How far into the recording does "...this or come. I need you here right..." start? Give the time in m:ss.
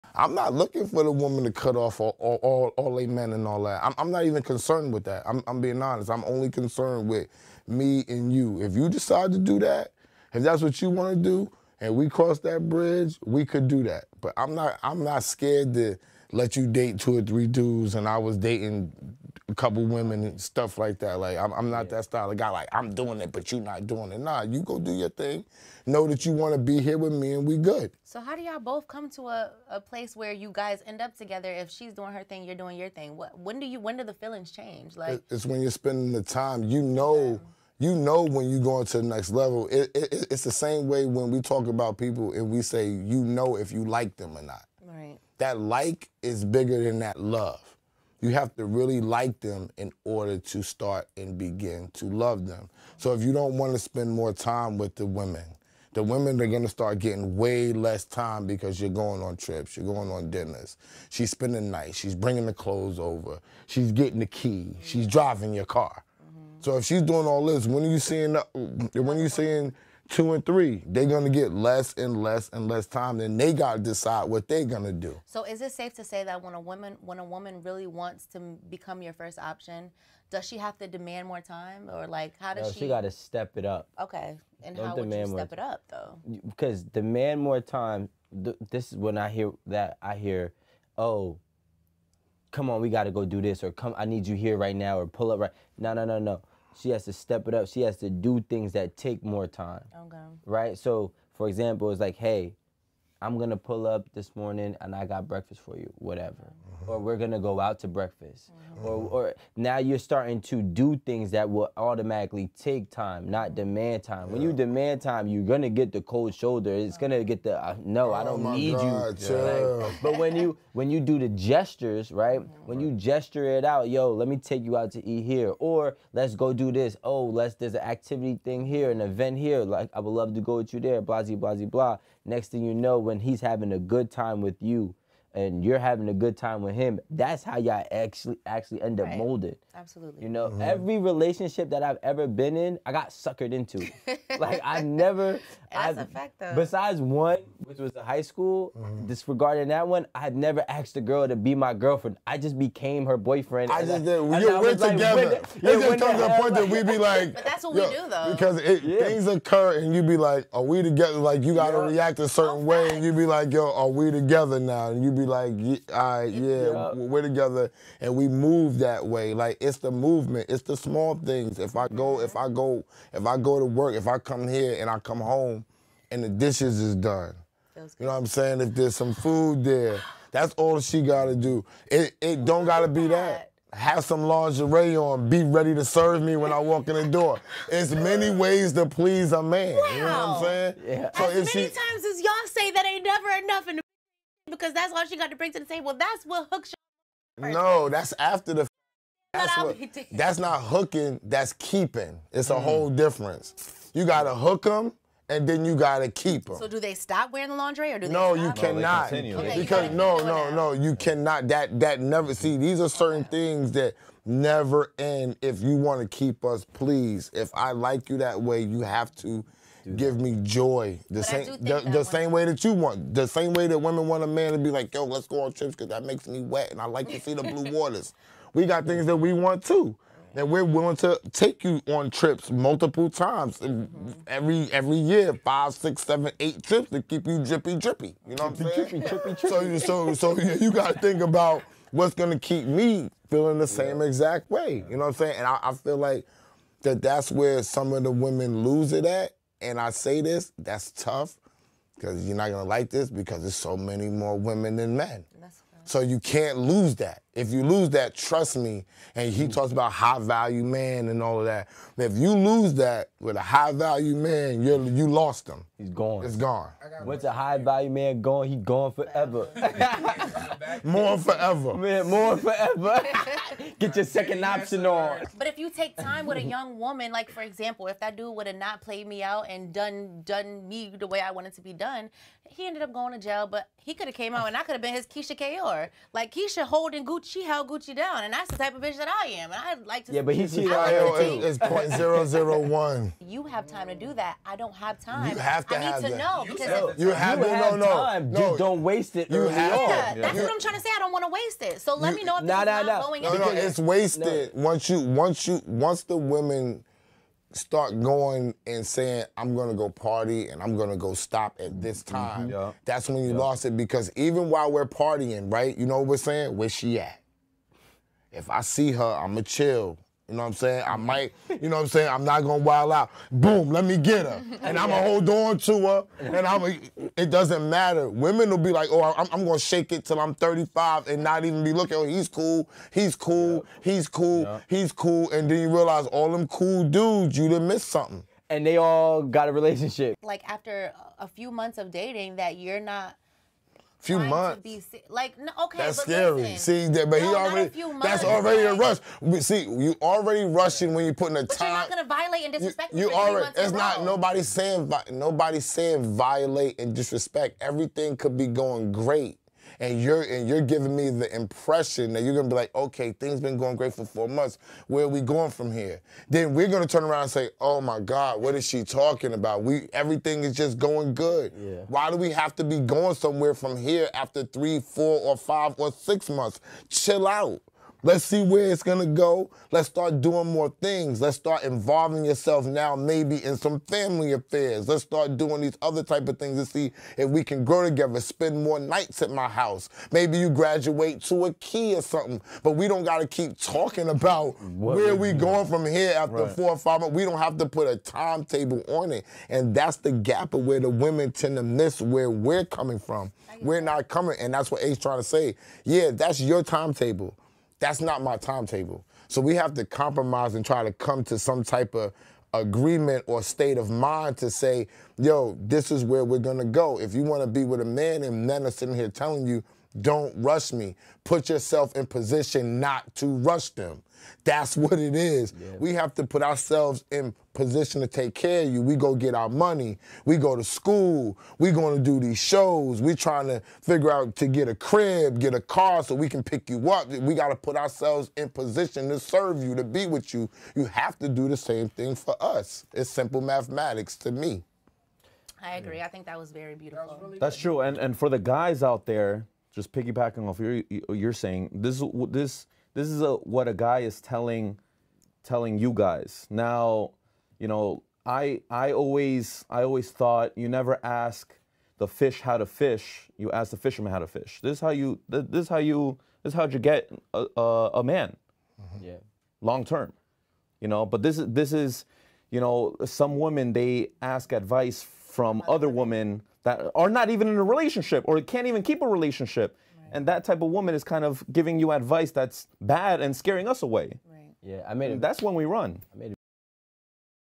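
1:33.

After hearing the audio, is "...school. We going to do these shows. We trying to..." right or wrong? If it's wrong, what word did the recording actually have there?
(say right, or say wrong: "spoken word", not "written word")
right.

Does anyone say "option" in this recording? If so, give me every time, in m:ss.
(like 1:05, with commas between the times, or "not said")
1:19, 4:34.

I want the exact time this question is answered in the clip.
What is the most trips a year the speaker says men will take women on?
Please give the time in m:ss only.
3:56.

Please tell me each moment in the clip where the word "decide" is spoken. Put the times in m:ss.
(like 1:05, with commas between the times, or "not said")
0:08, 1:13.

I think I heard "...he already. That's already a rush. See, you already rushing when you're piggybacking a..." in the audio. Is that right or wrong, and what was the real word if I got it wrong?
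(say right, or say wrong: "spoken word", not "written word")
wrong: "putting", not "piggybacking".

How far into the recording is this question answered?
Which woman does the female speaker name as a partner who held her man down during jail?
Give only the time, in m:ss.
4:45.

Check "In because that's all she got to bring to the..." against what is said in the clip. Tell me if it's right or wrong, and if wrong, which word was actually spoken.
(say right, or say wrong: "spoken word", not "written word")
right.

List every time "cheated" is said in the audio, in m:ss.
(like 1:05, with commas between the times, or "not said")
4:50.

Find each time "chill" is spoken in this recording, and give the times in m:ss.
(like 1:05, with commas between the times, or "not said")
5:19, 6:16.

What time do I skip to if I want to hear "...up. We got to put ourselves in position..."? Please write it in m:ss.
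7:16.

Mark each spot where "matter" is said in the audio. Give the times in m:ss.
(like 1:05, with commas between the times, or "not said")
5:27.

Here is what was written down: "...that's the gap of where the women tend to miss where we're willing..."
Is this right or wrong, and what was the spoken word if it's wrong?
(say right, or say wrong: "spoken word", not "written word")
wrong: "coming", not "willing".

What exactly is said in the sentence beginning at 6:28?
Spend more nights at my house.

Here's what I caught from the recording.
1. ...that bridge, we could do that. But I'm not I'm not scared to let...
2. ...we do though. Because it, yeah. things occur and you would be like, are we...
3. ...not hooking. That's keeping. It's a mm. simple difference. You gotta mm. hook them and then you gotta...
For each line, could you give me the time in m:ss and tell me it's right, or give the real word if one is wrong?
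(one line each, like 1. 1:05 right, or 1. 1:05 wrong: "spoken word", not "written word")
1. 0:12 right
2. 2:37 right
3. 3:20 wrong: "whole", not "simple".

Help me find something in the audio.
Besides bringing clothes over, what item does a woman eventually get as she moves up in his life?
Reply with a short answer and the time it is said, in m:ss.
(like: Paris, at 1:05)
the key, at 1:03.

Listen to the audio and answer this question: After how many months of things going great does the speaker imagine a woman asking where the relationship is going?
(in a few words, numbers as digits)
4.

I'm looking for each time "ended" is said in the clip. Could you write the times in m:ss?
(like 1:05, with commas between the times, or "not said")
4:42.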